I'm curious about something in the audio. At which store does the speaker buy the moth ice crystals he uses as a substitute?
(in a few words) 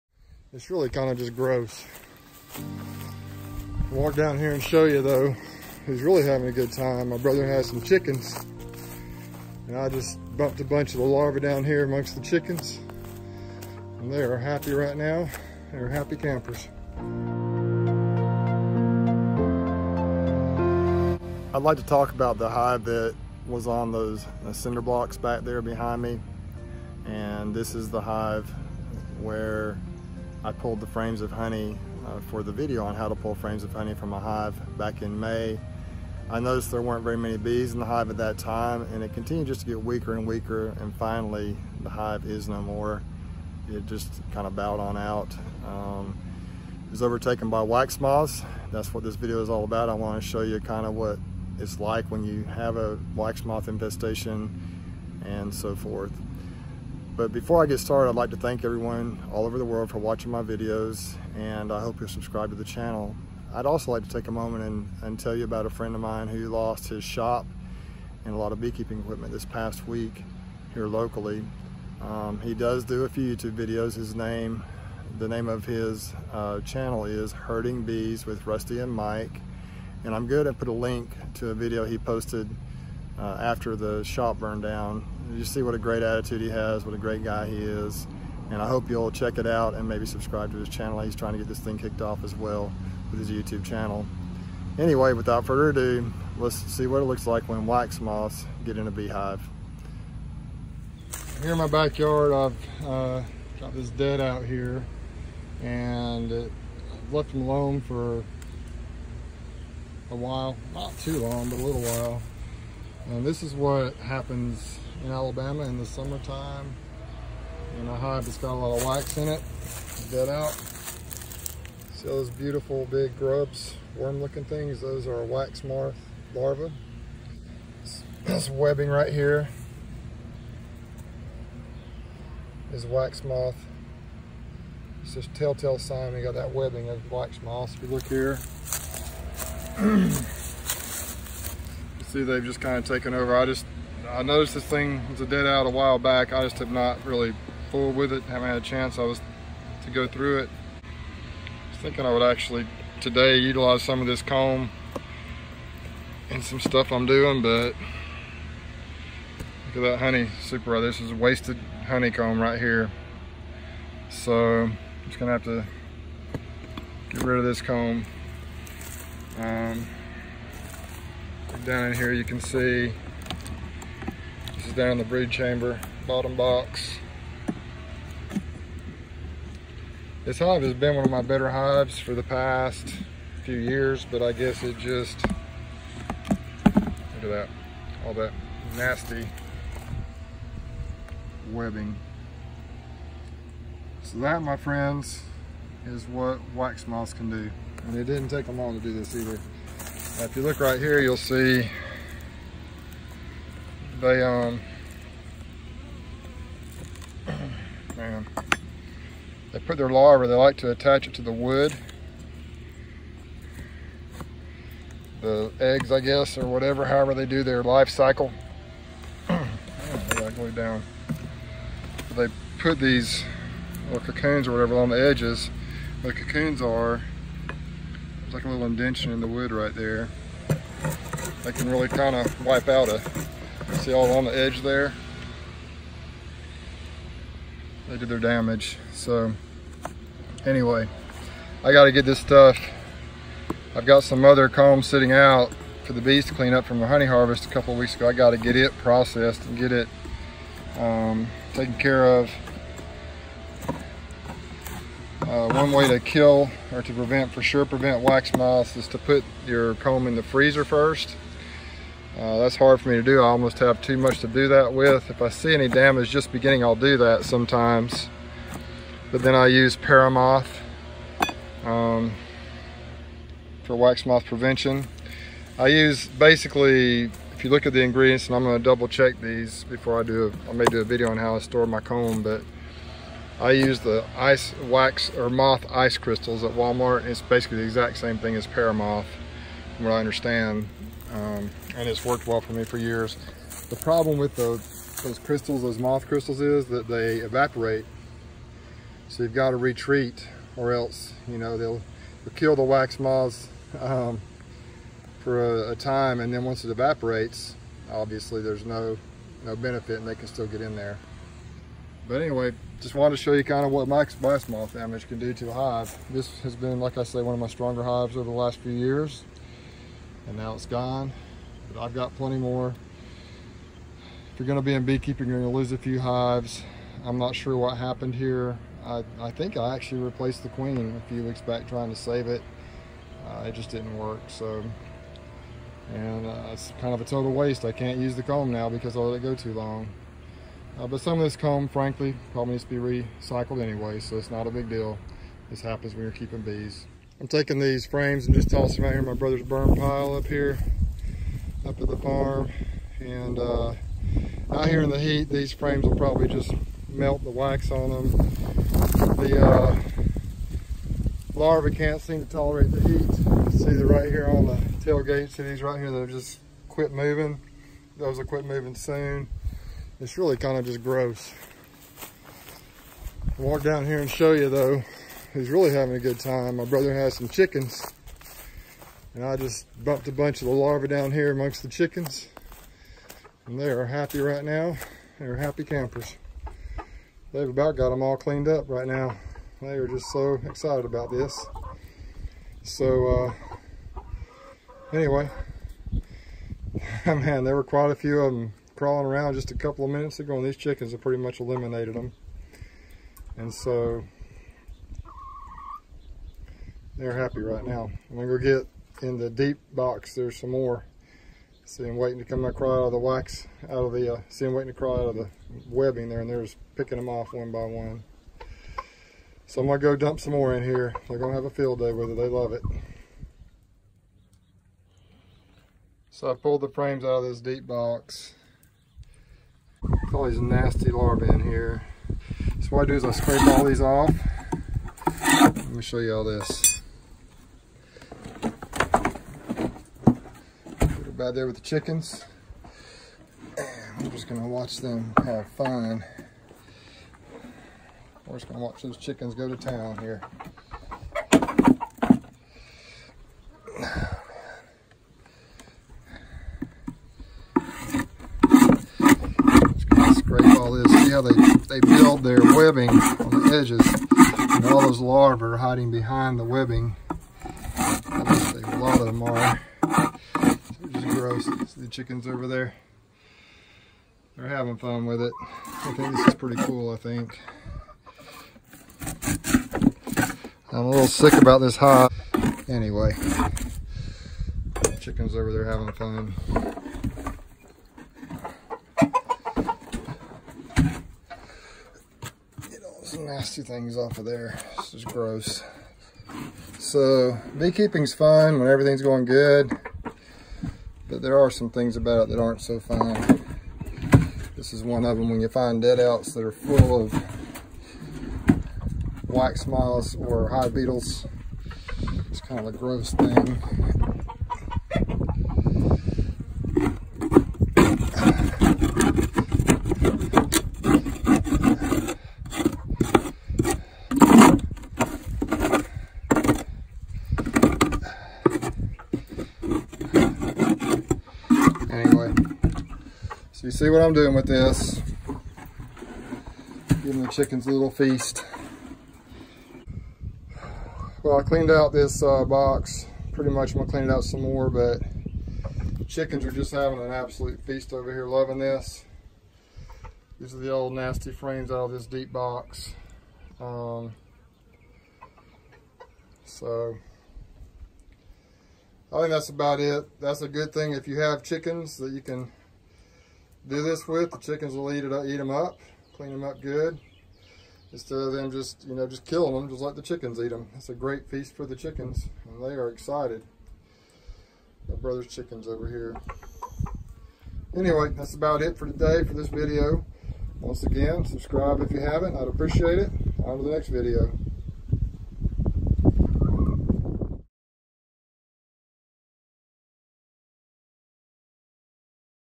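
Walmart.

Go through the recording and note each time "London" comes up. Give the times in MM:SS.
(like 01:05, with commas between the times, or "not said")
not said.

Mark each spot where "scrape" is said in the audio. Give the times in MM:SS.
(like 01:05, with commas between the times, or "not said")
07:13.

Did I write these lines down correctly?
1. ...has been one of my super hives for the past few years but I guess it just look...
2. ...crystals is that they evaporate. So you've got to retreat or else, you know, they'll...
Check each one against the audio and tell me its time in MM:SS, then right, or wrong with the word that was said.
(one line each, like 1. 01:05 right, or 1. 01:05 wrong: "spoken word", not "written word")
1. 03:00 wrong: "better", not "super"
2. 04:56 right.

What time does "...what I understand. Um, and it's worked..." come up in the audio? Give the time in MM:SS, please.
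04:49.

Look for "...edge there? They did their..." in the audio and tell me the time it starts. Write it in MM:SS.
03:54.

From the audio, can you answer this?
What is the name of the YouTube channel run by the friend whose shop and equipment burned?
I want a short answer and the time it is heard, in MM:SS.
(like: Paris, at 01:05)
Herding Bees with Rusty and Mike, at 01:17.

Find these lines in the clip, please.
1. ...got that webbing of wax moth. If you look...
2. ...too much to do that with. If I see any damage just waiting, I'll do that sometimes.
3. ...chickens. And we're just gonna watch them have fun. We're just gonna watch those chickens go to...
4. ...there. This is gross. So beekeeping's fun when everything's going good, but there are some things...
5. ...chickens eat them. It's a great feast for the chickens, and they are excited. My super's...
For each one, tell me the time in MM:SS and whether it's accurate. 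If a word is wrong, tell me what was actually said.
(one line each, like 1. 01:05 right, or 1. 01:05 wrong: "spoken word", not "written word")
1. 02:16 right
2. 04:23 wrong: "beginning", not "waiting"
3. 07:21 right
4. 08:14 right
5. 09:30 wrong: "brother", not "super".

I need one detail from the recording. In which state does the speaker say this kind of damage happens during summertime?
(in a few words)
Alabama.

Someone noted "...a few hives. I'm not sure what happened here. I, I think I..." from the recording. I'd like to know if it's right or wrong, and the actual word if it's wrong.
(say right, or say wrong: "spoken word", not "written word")
right.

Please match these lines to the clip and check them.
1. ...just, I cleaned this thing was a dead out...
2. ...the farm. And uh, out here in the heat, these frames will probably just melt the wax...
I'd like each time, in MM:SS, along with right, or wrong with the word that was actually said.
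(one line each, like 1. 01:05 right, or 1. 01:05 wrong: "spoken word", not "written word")
1. 02:23 wrong: "noticed", not "cleaned"
2. 05:51 right.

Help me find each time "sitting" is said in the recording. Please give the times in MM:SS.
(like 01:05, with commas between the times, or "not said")
04:04.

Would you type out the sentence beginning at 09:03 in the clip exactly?
Pretty much I'm gonna clean it out some more, but chickens are just having an absolute feast over here, loving this.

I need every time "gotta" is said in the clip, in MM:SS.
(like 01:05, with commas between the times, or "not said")
04:01, 04:08.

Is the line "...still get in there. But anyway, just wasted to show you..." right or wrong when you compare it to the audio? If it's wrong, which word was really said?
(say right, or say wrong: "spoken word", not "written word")
wrong: "wanted", not "wasted".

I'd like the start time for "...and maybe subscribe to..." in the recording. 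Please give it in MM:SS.
01:29.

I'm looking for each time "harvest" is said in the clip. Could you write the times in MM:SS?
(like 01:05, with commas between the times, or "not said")
04:07.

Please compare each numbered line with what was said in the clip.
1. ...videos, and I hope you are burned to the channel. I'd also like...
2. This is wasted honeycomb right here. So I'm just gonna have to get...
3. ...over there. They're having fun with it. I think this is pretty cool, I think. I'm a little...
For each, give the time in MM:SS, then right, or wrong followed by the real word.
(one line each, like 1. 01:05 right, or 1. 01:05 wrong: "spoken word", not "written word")
1. 01:00 wrong: "subscribed", not "burned"
2. 02:40 right
3. 07:52 right.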